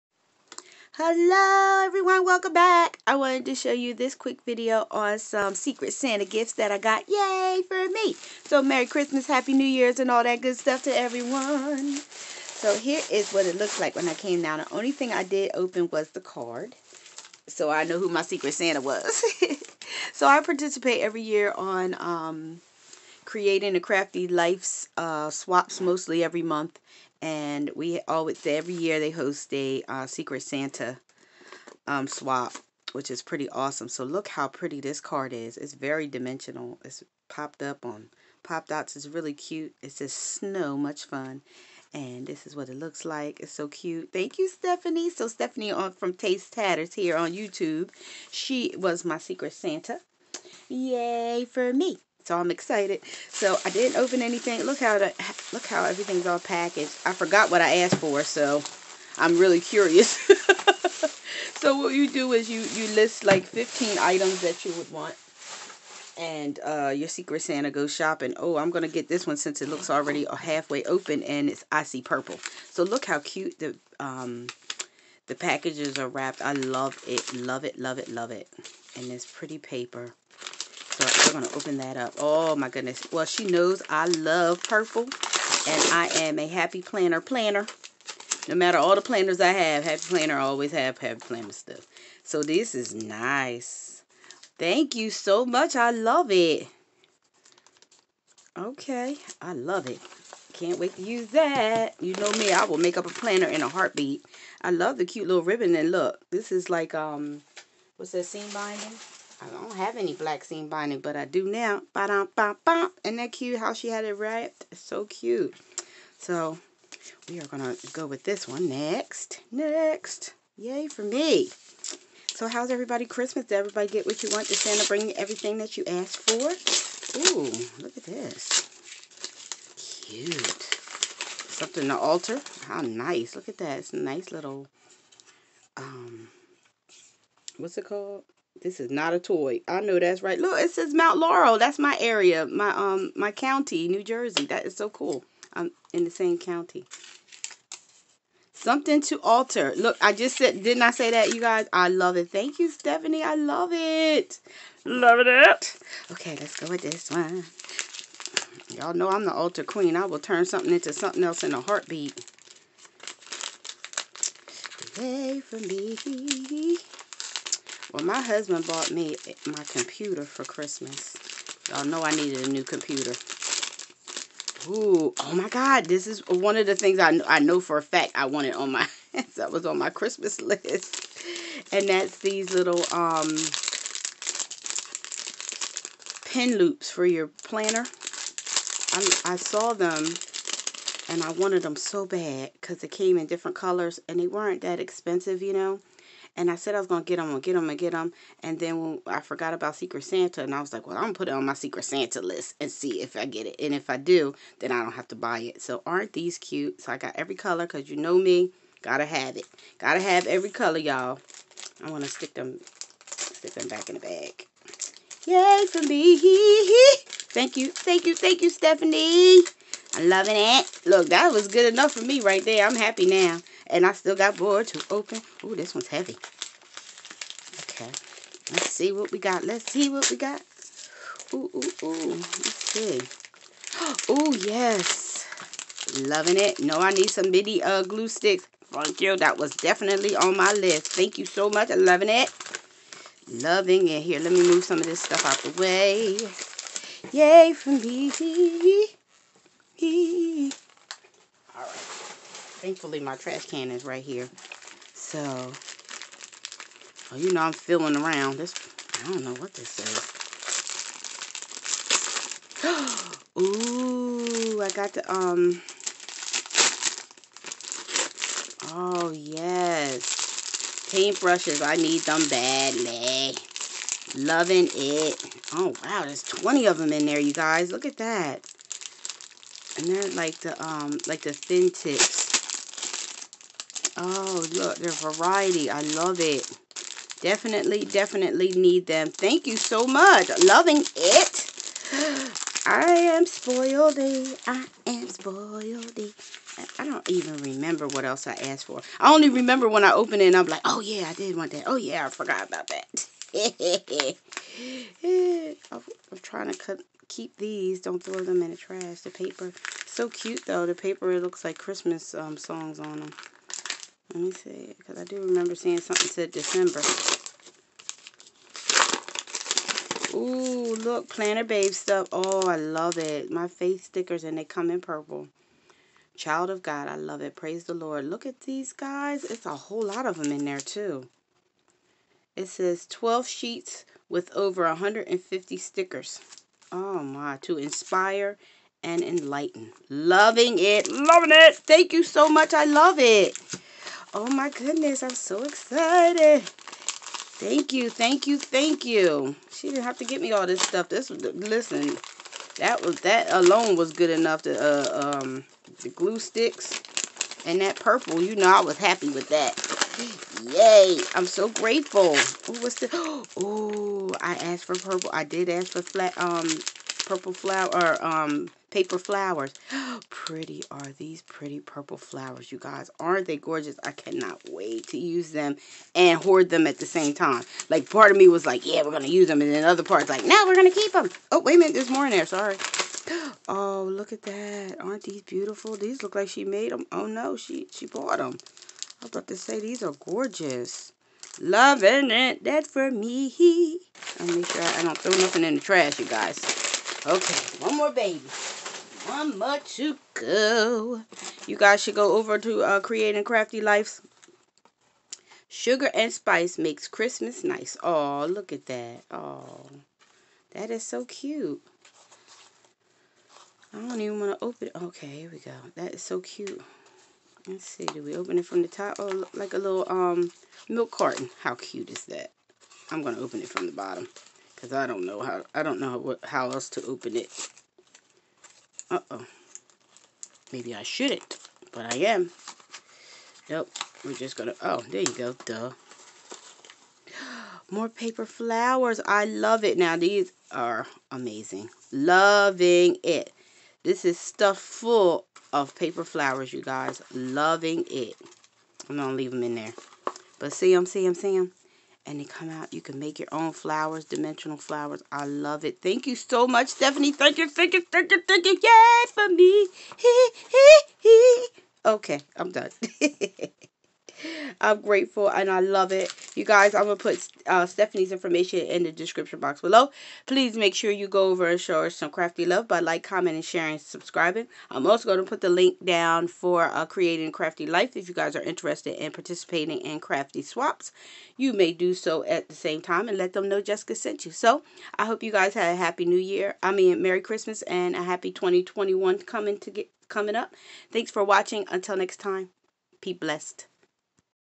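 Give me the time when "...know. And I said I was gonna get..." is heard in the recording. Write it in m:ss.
3:15.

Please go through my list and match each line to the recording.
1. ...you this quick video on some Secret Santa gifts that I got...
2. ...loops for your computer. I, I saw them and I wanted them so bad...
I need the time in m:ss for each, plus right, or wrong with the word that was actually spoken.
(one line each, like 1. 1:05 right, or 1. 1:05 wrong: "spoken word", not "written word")
1. 0:03 right
2. 3:06 wrong: "planner", not "computer".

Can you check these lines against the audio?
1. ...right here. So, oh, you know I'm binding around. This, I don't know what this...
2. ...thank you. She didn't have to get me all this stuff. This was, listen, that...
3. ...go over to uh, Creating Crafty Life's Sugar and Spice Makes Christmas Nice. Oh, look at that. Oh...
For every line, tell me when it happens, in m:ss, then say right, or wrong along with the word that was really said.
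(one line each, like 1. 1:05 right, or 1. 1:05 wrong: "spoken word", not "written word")
1. 4:13 wrong: "feeling", not "binding"
2. 5:48 right
3. 6:41 right.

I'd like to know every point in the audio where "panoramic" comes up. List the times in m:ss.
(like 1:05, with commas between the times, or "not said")
not said.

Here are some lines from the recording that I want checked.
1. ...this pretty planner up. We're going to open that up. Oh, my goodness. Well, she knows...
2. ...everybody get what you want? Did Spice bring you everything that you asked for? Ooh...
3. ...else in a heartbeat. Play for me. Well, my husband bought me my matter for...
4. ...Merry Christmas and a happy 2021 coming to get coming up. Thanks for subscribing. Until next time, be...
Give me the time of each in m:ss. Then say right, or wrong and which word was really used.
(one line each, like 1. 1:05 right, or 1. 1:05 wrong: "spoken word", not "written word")
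1. 1:19 wrong: "paper", not "planner"
2. 2:03 wrong: "Santa", not "Spice"
3. 2:41 wrong: "computer", not "matter"
4. 8:07 wrong: "watching", not "subscribing".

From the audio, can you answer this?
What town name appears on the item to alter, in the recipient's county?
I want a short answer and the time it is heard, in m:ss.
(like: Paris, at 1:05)
Mount Laurel, at 2:20.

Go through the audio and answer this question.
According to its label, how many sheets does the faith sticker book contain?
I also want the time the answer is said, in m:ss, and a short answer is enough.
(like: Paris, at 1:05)
12, at 5:32.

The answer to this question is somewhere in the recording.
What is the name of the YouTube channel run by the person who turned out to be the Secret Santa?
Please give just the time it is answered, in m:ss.
0:46.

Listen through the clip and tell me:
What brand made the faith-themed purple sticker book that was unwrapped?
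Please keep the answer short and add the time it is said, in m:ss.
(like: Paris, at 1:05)
Planner Babe, at 5:21.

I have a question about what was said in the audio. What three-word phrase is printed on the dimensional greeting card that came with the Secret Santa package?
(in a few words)
Snow much fun.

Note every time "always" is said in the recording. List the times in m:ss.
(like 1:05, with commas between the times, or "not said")
0:28, 1:30.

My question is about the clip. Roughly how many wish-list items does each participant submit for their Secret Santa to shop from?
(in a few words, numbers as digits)
15.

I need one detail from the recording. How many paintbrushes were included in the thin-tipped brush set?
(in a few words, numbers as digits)
20.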